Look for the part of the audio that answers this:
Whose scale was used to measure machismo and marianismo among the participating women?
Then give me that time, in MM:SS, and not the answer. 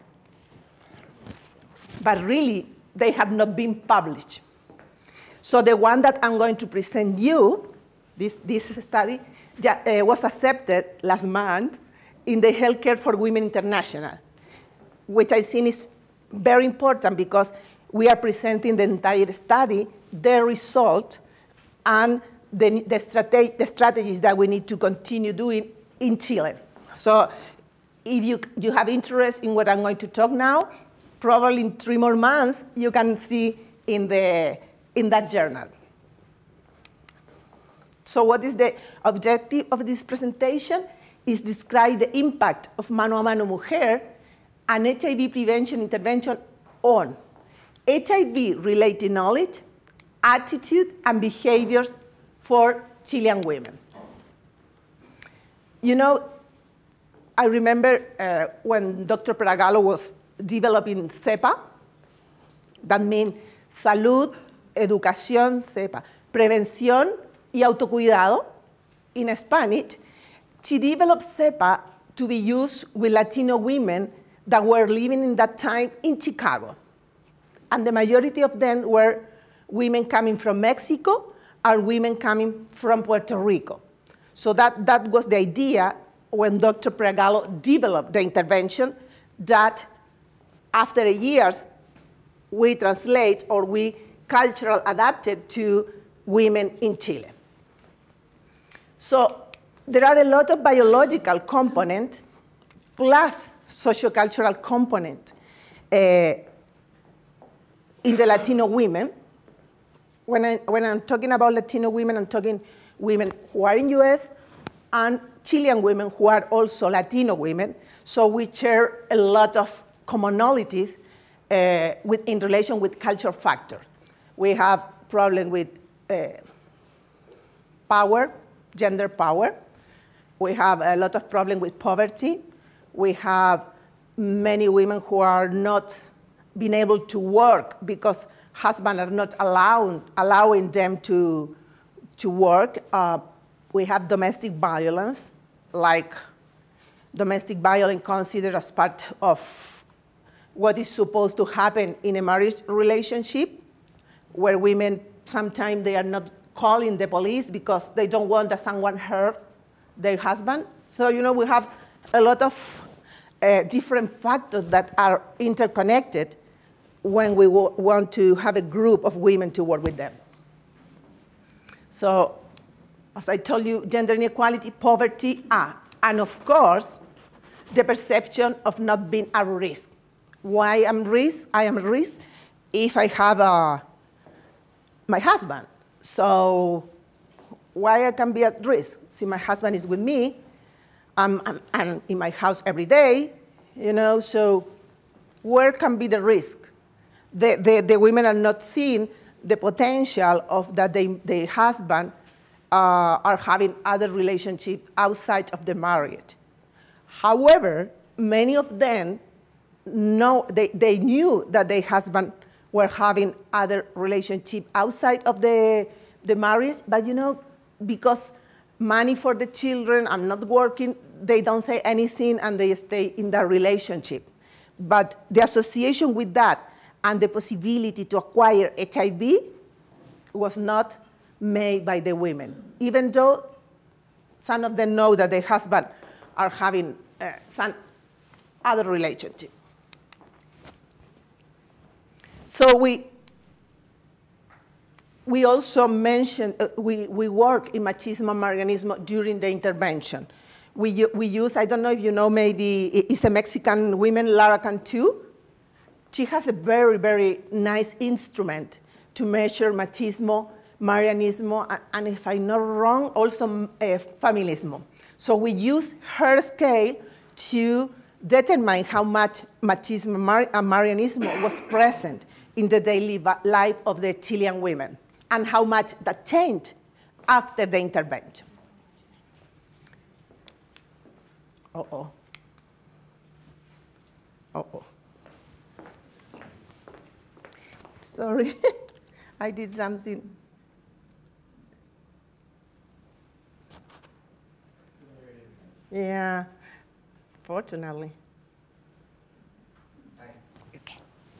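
04:14.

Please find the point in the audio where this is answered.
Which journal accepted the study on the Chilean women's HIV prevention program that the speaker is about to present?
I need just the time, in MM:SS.
00:12.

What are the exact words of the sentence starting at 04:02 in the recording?
So we, we also mentioned, uh, we, we work in machismo and marianismo during the intervention.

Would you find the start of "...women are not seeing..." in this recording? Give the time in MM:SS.
03:17.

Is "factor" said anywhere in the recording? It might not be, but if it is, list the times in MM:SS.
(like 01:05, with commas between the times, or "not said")
02:03, 02:44.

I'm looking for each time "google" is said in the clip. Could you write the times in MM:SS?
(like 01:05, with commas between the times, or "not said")
not said.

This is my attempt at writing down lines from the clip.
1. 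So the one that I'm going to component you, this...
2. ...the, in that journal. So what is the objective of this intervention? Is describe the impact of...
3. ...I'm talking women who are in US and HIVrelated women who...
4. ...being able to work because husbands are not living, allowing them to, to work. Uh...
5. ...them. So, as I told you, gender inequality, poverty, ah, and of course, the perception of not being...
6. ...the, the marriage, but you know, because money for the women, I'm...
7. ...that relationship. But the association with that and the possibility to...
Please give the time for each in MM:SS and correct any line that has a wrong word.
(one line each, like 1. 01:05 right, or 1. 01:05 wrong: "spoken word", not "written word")
1. 00:05 wrong: "present", not "component"
2. 00:34 wrong: "presentation", not "intervention"
3. 01:52 wrong: "Chilean", not "HIVrelated"
4. 02:16 wrong: "allowing", not "living"
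5. 02:49 right
6. 03:35 wrong: "children", not "women"
7. 03:43 right.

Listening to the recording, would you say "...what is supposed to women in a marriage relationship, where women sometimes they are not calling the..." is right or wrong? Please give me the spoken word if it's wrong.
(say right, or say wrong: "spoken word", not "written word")
wrong: "happen", not "women".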